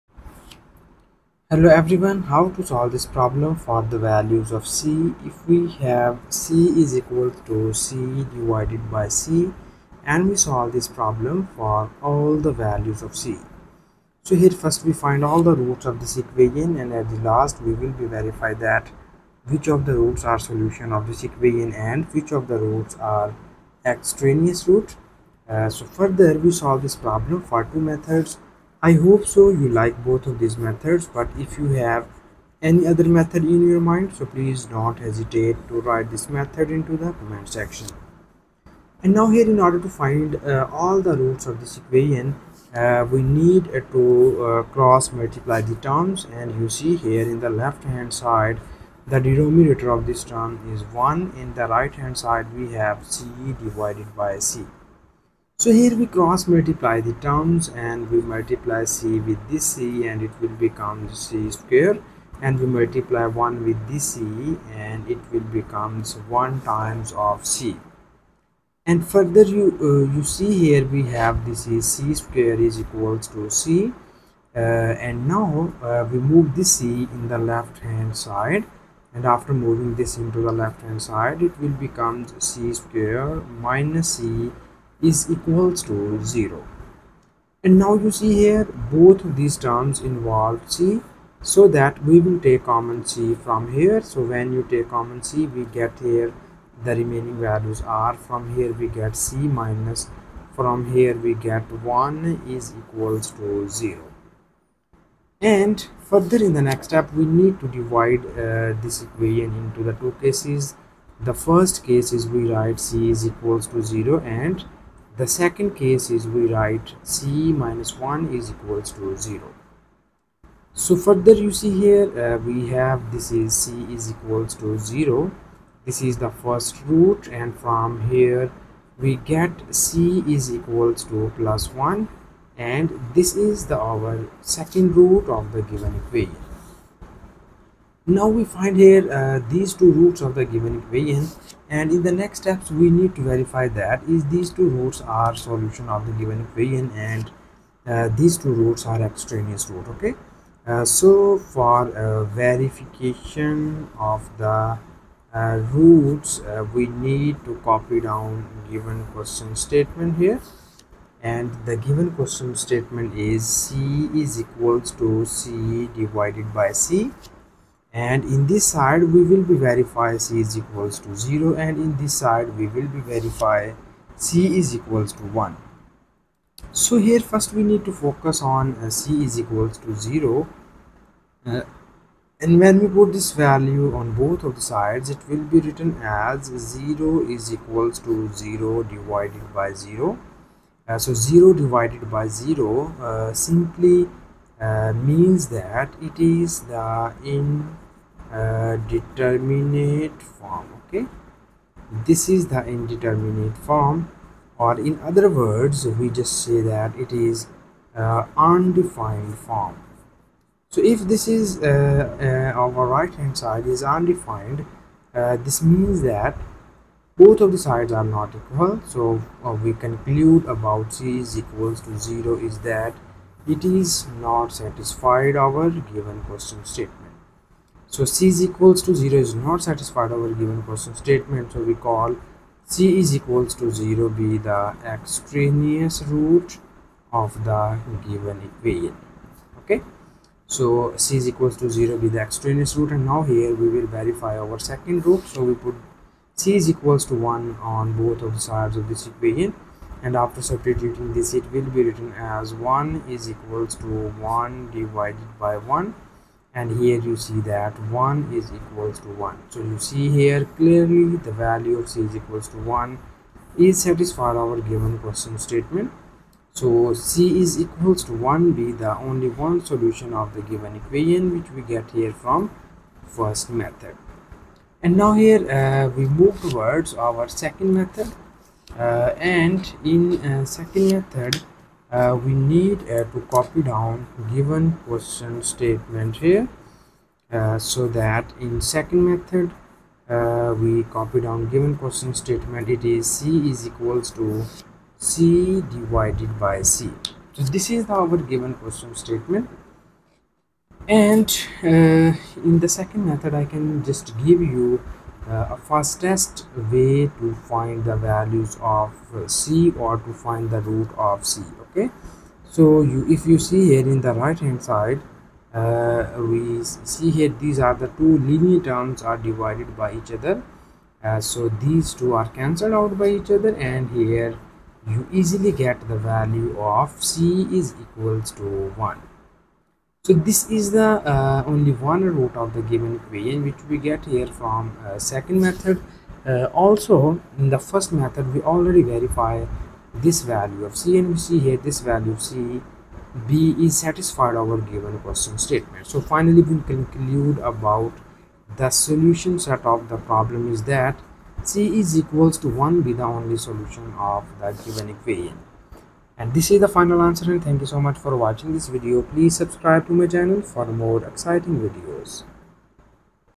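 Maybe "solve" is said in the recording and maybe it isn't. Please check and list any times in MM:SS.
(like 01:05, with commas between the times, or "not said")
00:02, 00:10, 00:26.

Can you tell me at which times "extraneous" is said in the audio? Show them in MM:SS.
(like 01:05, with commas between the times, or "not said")
00:23, 02:29, 03:54, 04:02.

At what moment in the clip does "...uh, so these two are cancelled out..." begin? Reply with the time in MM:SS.
05:21.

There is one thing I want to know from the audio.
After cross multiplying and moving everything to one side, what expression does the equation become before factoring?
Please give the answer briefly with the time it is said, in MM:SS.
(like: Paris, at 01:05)
c^2 - c = 0, at 01:22.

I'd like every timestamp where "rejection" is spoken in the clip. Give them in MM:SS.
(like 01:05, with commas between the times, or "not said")
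not said.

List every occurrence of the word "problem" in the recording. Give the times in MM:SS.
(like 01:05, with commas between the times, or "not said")
00:03, 00:10, 00:27, 05:50.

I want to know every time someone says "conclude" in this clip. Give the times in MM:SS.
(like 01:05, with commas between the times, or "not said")
03:39, 05:46.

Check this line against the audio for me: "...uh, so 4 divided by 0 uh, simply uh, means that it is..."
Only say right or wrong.
wrong.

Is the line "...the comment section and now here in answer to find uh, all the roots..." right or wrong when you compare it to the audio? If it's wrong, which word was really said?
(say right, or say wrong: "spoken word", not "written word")
wrong: "order", not "answer".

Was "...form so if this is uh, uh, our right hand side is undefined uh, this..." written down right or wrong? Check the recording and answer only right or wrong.
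right.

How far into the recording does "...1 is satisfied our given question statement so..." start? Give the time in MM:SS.
04:22.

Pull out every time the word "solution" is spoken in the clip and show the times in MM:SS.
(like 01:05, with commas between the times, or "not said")
00:20, 02:25, 04:29, 05:48, 05:53.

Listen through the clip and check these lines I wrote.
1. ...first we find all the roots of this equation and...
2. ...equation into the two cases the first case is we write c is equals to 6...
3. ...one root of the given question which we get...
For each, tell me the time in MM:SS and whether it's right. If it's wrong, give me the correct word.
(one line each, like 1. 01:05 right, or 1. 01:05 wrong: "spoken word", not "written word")
1. 00:14 right
2. 01:49 wrong: "0", not "6"
3. 05:31 wrong: "equation", not "question".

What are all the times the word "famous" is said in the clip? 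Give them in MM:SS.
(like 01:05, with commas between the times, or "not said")
not said.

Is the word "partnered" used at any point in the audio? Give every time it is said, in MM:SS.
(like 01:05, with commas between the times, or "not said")
not said.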